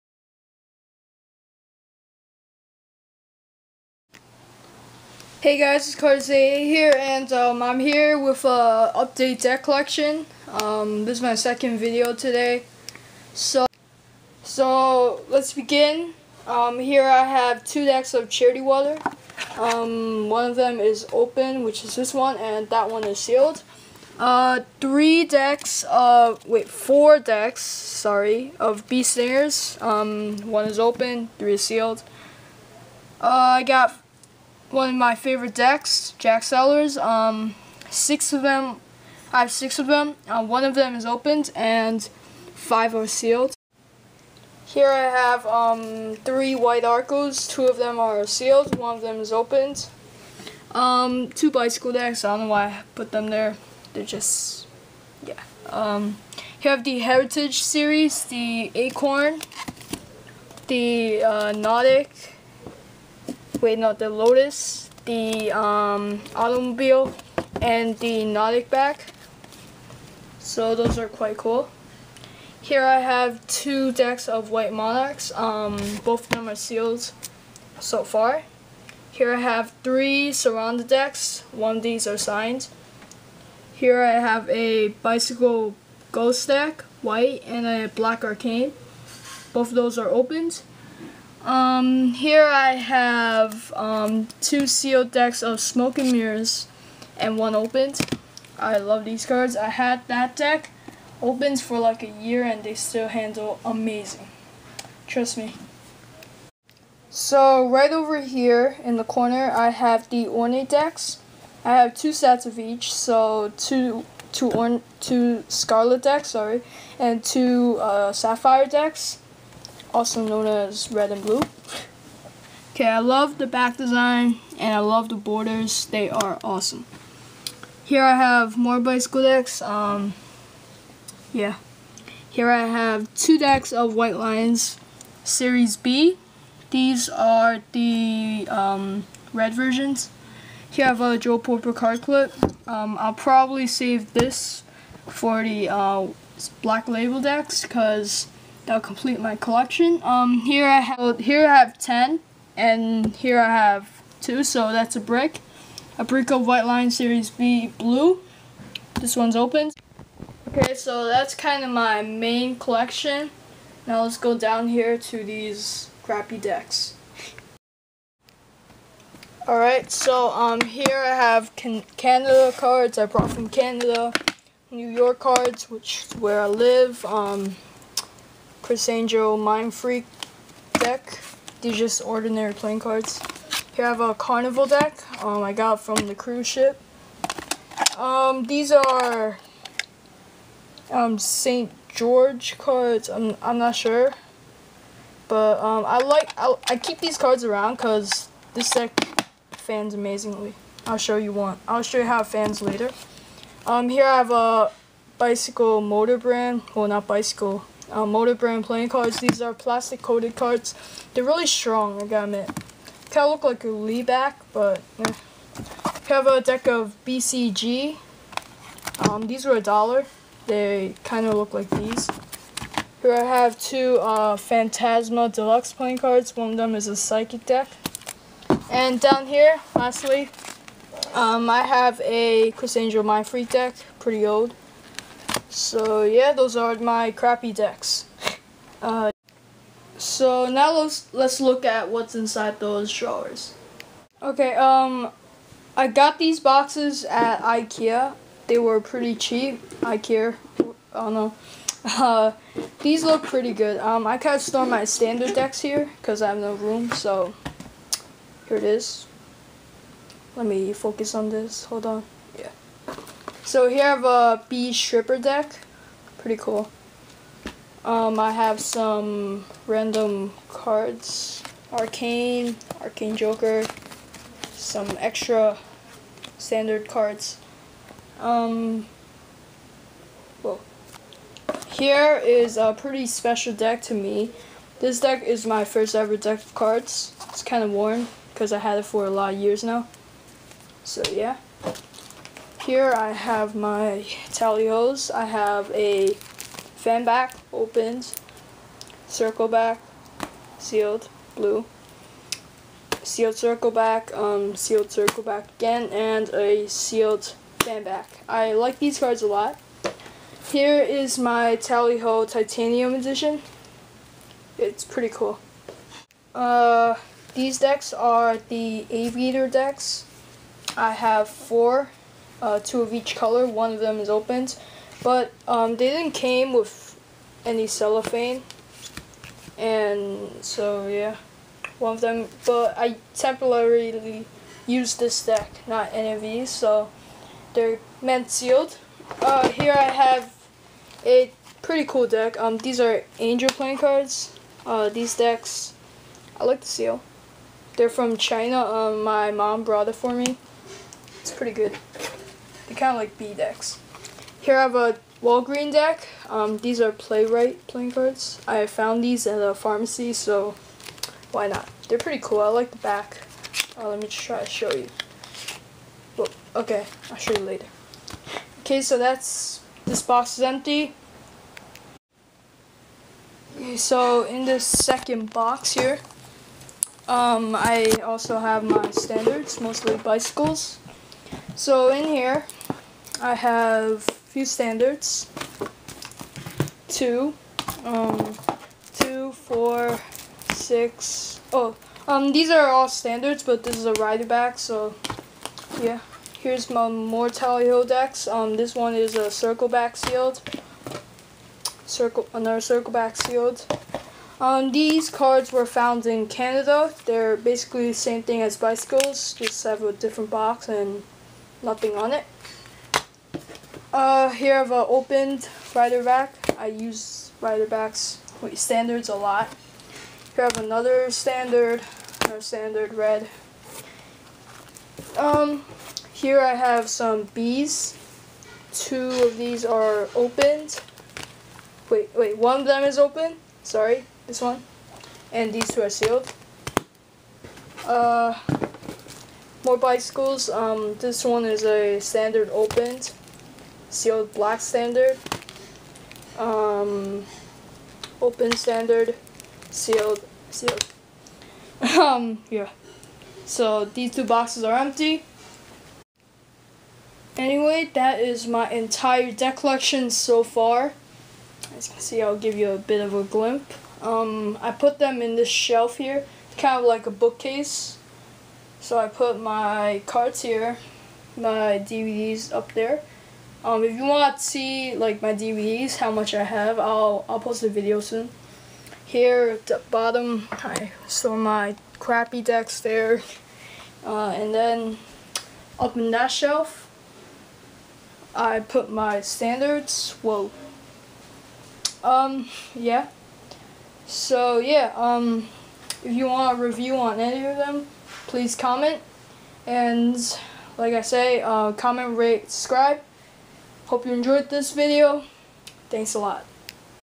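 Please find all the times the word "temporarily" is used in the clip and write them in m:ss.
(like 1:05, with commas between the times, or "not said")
5:33.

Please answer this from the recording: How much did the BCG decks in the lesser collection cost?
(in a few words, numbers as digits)
A dollar.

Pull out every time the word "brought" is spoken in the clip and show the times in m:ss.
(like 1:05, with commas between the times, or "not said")
2:53, 5:49.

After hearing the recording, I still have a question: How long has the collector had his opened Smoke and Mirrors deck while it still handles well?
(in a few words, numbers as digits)
Like a year.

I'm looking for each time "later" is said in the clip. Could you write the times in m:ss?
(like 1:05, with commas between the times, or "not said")
3:22, 6:07.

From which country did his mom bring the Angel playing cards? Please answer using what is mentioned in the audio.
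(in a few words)
China.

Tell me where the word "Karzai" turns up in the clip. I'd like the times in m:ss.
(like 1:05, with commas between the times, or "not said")
0:05.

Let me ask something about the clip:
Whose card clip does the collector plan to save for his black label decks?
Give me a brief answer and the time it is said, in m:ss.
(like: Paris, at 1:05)
Joe Porter, at 2:21.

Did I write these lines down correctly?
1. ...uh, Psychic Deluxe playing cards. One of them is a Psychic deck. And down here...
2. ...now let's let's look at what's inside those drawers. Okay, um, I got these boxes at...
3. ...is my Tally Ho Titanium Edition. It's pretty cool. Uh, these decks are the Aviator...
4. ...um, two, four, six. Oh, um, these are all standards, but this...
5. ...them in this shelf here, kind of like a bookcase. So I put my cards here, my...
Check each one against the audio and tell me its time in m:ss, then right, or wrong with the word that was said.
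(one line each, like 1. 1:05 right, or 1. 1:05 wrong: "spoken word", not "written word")
1. 3:43 wrong: "Phantasma", not "Psychic"
2. 4:00 right
3. 5:10 right
4. 6:27 right
5. 7:44 right.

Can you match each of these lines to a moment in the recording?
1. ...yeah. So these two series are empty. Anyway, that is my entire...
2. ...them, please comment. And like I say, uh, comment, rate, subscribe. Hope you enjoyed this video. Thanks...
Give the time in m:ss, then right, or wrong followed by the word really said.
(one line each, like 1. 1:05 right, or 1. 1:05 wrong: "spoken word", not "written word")
1. 7:32 wrong: "boxes", not "series"
2. 8:17 right.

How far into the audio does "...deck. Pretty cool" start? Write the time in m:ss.
4:25.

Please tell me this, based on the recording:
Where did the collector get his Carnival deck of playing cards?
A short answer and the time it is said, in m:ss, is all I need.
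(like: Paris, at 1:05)
The cruise ship, at 3:06.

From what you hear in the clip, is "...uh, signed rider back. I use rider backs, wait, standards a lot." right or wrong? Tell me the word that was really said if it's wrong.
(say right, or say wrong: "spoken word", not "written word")
wrong: "opened", not "signed".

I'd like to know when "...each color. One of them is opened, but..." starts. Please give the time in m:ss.
5:22.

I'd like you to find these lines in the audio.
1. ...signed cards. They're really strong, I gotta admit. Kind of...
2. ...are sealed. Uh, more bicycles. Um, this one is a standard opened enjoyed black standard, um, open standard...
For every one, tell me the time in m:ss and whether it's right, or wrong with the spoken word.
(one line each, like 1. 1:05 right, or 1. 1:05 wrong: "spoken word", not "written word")
1. 3:30 wrong: "coated", not "signed"
2. 7:15 wrong: "sealed", not "enjoyed".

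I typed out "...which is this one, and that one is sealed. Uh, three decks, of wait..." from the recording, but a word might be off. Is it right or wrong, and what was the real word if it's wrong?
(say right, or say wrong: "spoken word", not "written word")
right.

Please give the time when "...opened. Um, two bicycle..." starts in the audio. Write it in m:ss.
0:49.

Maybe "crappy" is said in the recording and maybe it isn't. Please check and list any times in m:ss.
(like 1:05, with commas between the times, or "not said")
2:46, 3:57, 8:01.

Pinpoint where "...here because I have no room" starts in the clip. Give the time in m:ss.
4:15.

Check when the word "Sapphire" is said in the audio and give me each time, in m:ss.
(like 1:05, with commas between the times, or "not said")
1:58.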